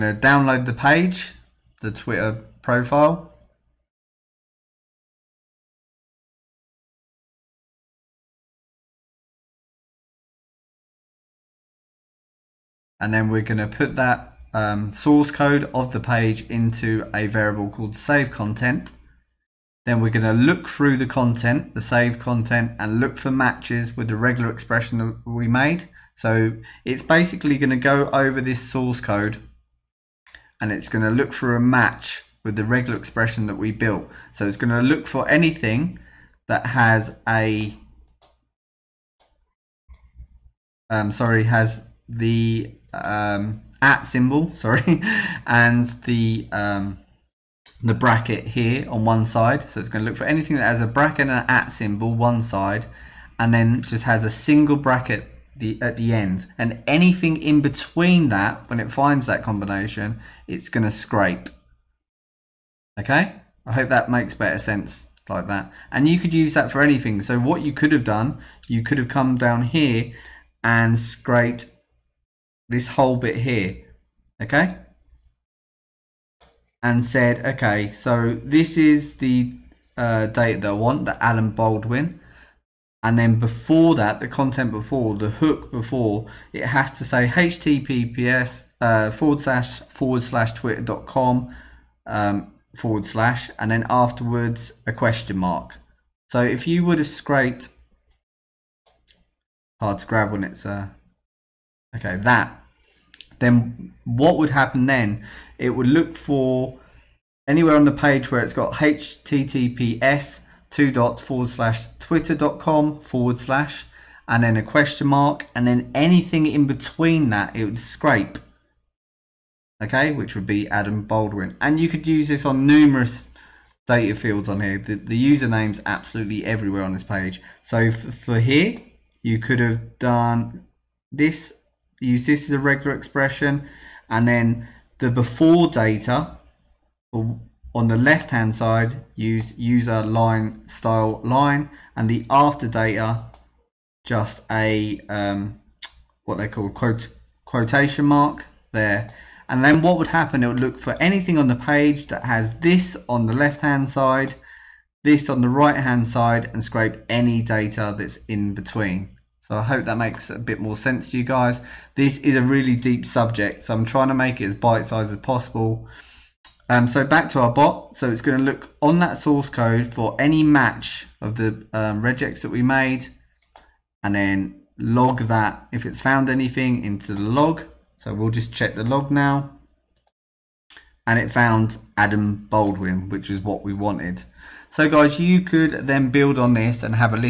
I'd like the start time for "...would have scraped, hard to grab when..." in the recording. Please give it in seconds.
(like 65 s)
96 s.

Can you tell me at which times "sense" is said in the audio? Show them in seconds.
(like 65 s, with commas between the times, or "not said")
64 s, 160 s.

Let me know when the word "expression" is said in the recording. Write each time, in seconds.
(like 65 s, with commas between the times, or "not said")
24 s, 32 s, 132 s.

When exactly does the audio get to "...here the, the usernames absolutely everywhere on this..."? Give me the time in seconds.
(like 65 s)
124 s.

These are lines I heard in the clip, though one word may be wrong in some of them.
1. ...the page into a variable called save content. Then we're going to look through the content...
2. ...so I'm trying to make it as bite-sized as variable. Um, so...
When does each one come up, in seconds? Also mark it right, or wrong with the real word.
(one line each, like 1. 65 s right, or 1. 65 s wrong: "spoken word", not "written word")
1. 15 s right
2. 163 s wrong: "possible", not "variable".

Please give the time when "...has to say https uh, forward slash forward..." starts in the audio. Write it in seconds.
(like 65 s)
86 s.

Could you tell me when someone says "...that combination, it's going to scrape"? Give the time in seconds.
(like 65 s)
59 s.